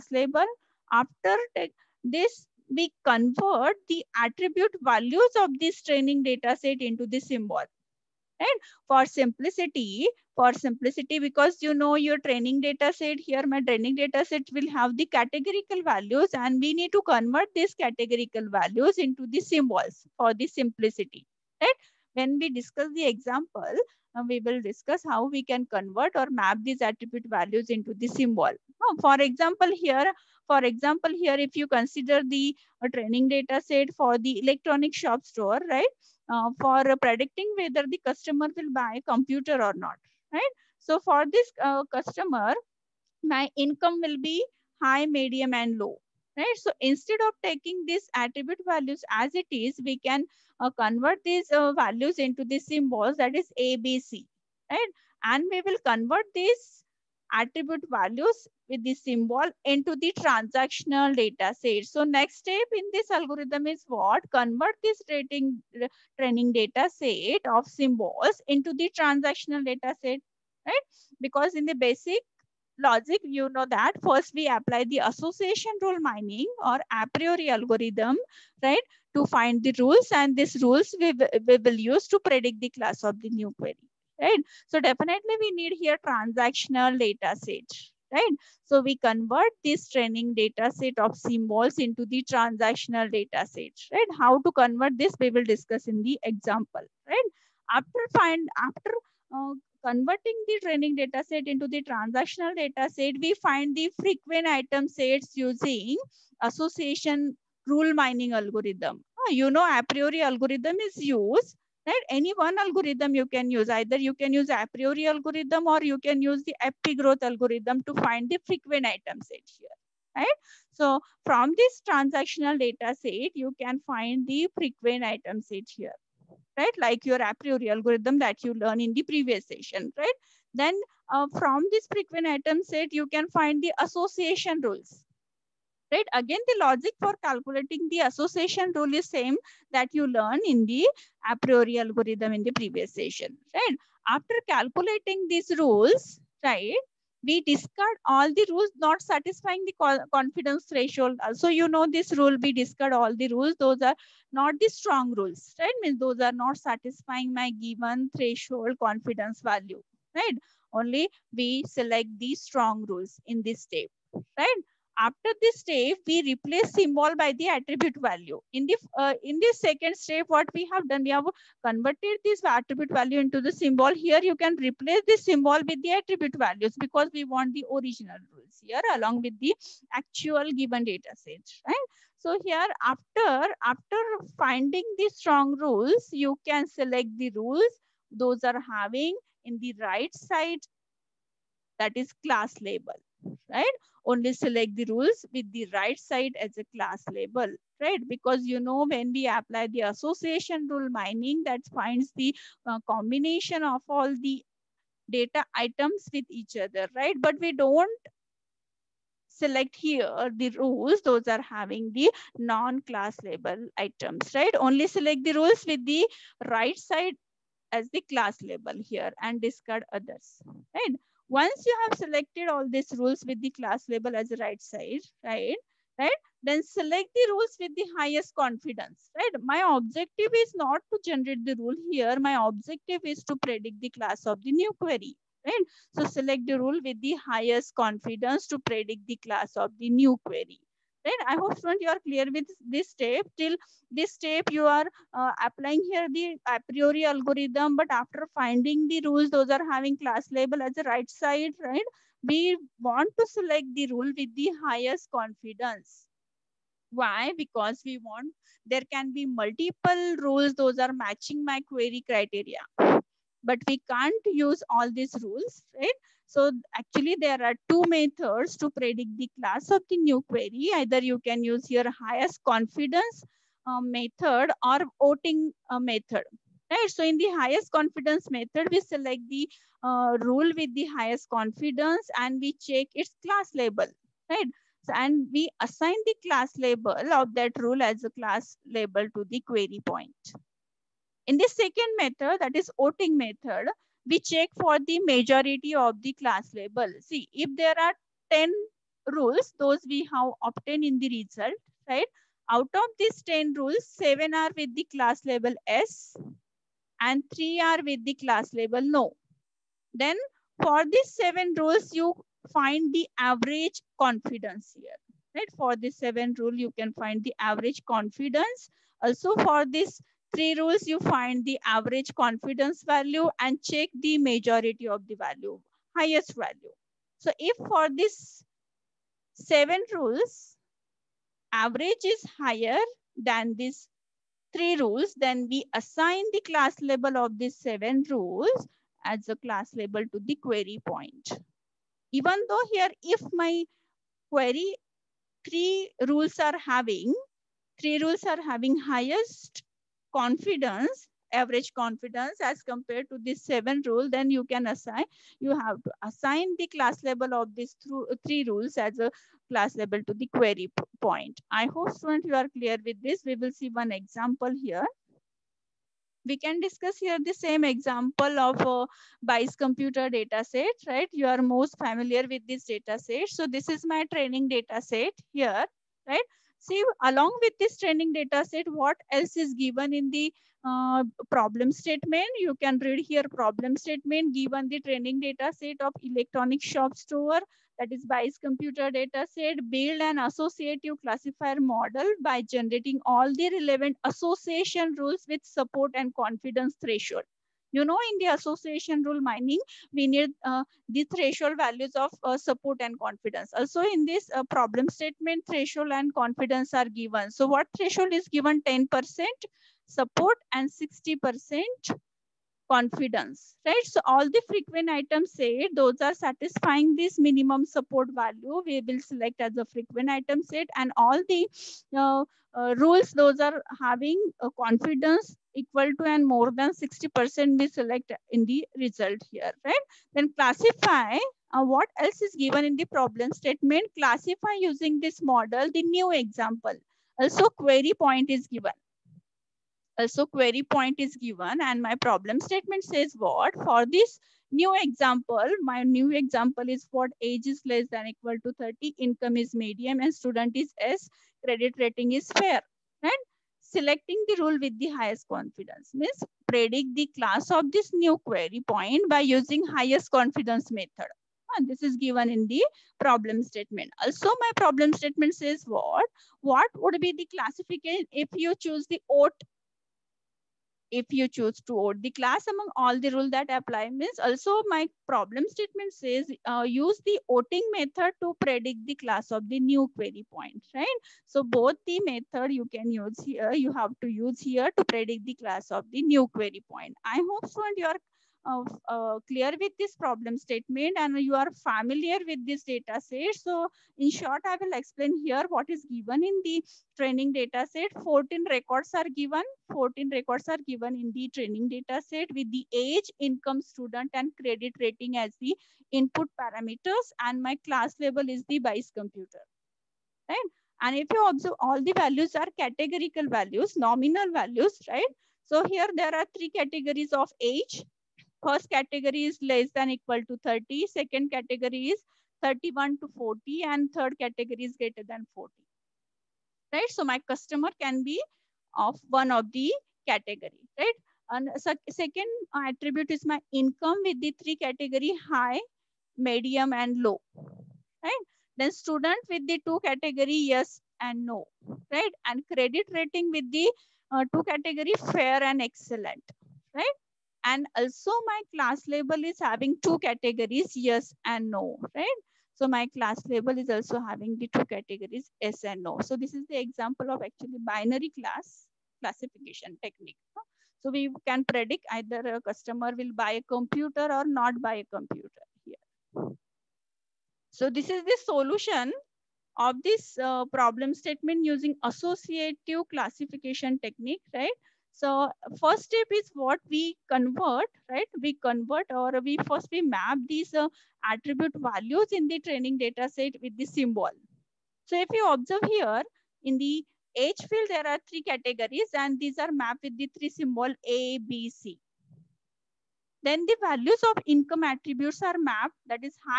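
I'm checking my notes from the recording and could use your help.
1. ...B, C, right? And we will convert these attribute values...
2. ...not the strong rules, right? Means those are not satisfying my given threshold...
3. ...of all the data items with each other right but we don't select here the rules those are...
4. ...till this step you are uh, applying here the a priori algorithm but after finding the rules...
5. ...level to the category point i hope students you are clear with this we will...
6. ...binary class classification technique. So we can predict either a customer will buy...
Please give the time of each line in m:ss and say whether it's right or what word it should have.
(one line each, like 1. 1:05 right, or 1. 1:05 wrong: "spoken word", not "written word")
1. 0:53 right
2. 2:34 right
3. 3:23 right
4. 4:03 right
5. 5:59 wrong: "query", not "category"
6. 9:17 right.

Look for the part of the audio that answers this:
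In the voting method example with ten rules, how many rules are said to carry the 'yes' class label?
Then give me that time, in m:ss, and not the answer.
5:03.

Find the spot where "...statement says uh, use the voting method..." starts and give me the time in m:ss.
7:55.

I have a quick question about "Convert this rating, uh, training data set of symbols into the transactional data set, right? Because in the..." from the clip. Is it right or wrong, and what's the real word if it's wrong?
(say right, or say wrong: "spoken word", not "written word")
right.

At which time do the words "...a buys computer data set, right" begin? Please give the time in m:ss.
6:08.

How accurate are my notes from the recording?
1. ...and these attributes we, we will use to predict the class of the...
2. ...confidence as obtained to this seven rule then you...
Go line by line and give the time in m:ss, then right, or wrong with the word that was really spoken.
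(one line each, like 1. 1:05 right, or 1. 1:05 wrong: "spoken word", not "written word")
1. 1:20 wrong: "rules", not "attributes"
2. 5:51 wrong: "compared", not "obtained".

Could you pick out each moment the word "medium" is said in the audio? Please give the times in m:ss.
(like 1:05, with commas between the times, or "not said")
0:45, 7:29, 8:56.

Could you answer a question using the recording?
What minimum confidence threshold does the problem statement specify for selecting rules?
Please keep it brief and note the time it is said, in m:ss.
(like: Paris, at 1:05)
60%, at 6:50.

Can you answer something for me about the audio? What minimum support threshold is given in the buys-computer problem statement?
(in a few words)
10%.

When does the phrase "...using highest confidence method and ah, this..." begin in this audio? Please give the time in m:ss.
7:39.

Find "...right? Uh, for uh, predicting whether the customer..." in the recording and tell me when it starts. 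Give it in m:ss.
0:35.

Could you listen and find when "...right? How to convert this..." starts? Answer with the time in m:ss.
1:33.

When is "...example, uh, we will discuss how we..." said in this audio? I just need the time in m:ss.
0:23.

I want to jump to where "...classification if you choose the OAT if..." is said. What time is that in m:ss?
7:47.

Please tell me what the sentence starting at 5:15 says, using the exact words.
For this 7 rule, you can find the average confidence.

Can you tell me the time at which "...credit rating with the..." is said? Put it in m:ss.
9:02.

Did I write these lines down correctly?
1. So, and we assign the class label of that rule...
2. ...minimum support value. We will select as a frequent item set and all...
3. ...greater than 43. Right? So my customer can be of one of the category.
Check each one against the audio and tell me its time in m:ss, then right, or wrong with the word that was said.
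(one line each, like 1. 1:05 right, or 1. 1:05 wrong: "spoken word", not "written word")
1. 4:44 right
2. 6:57 right
3. 8:44 wrong: "40", not "43".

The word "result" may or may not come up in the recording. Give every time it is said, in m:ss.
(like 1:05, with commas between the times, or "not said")
5:01, 7:08.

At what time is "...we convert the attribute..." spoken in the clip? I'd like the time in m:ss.
0:02.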